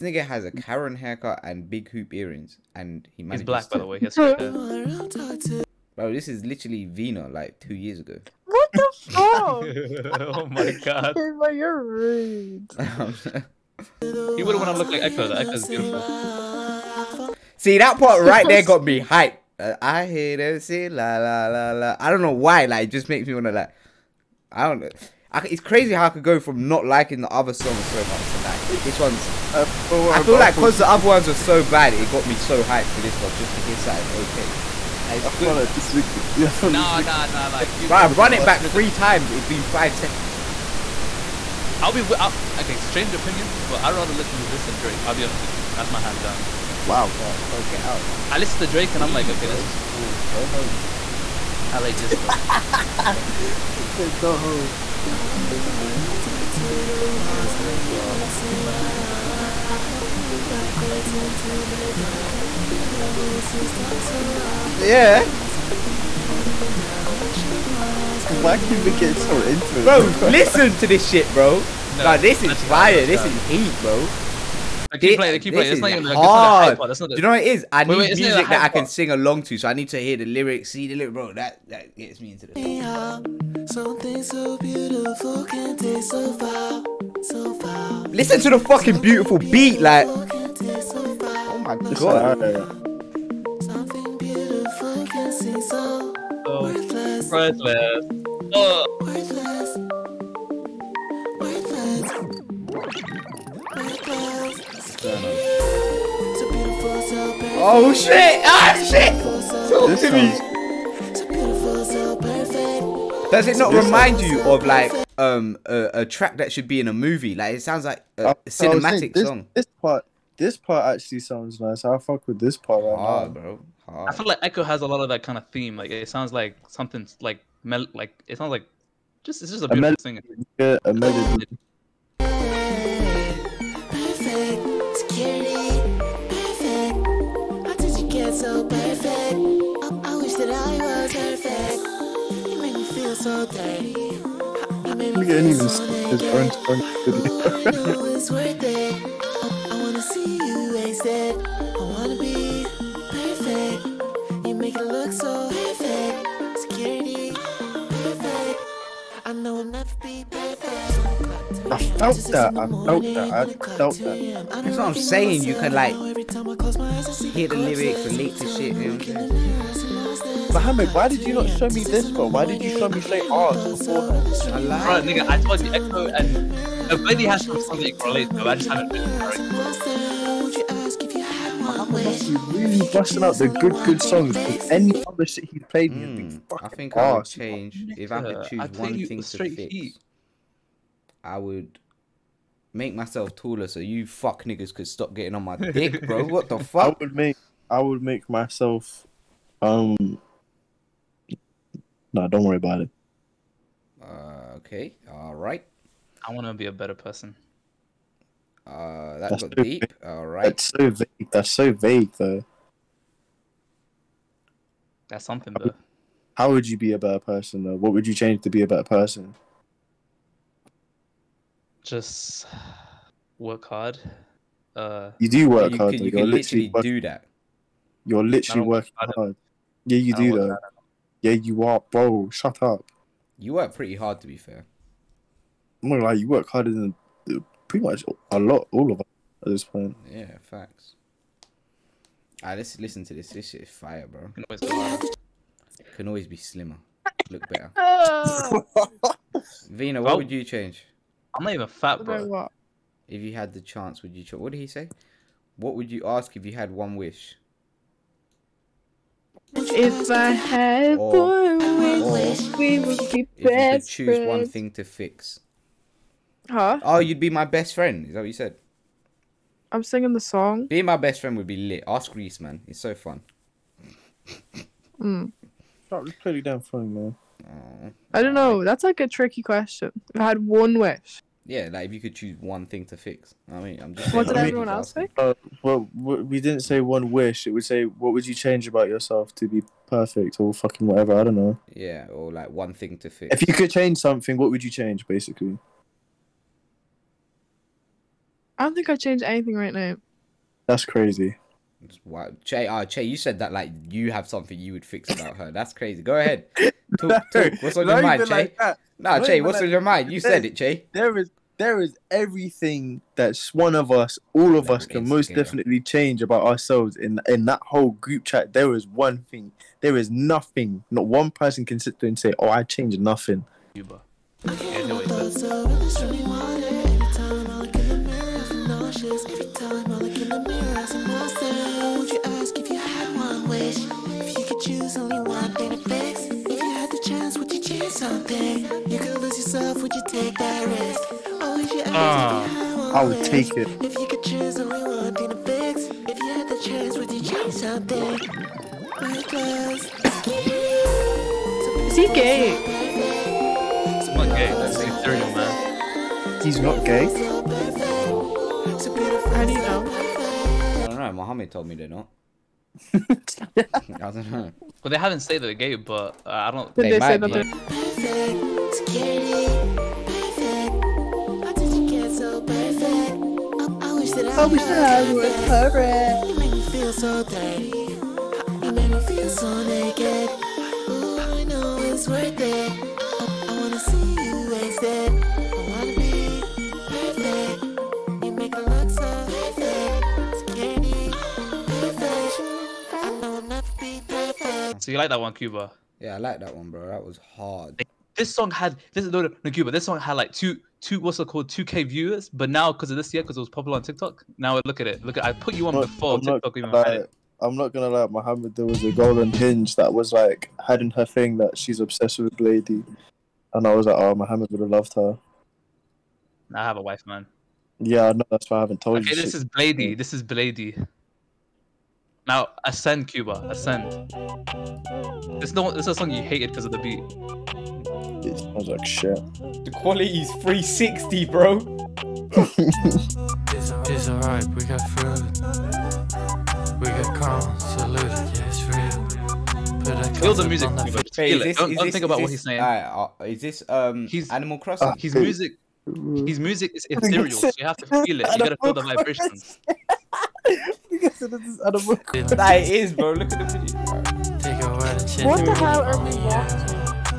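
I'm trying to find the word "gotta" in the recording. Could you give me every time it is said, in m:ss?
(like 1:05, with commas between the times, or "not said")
7:28.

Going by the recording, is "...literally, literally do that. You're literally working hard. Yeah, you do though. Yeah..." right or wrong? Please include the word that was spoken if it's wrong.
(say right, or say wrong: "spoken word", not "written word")
right.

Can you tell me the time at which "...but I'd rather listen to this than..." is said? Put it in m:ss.
0:43.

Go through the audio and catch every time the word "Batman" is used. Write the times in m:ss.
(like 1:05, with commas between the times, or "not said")
not said.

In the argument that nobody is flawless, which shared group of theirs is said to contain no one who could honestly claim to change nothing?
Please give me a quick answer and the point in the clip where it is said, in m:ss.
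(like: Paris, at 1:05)
group chat, at 5:17.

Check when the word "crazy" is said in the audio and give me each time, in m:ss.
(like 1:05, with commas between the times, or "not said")
0:25, 5:00, 5:05.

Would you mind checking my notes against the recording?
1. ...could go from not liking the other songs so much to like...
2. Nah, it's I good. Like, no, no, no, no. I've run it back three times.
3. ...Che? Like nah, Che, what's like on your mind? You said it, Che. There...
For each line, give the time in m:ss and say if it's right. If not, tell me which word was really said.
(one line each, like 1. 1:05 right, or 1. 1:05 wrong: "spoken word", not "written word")
1. 0:26 right
2. 0:35 right
3. 5:08 right.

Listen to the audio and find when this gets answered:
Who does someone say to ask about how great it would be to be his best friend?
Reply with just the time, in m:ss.
4:32.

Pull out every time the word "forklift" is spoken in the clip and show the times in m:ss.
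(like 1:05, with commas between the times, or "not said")
not said.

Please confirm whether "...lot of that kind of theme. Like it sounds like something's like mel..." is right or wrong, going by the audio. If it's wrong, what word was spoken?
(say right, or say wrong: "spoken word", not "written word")
right.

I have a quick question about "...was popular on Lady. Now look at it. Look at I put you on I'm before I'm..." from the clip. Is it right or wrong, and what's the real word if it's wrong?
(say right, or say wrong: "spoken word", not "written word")
wrong: "TikTok", not "Lady".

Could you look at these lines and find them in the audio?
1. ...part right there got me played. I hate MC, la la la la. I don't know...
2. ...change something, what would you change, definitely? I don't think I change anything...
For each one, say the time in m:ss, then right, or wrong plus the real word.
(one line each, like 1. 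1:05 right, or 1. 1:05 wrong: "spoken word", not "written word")
1. 0:17 wrong: "hyped", not "played"
2. 4:53 wrong: "basically", not "definitely".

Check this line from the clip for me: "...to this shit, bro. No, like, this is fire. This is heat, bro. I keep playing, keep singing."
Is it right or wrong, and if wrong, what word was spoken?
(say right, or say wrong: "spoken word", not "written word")
wrong: "playing", not "singing".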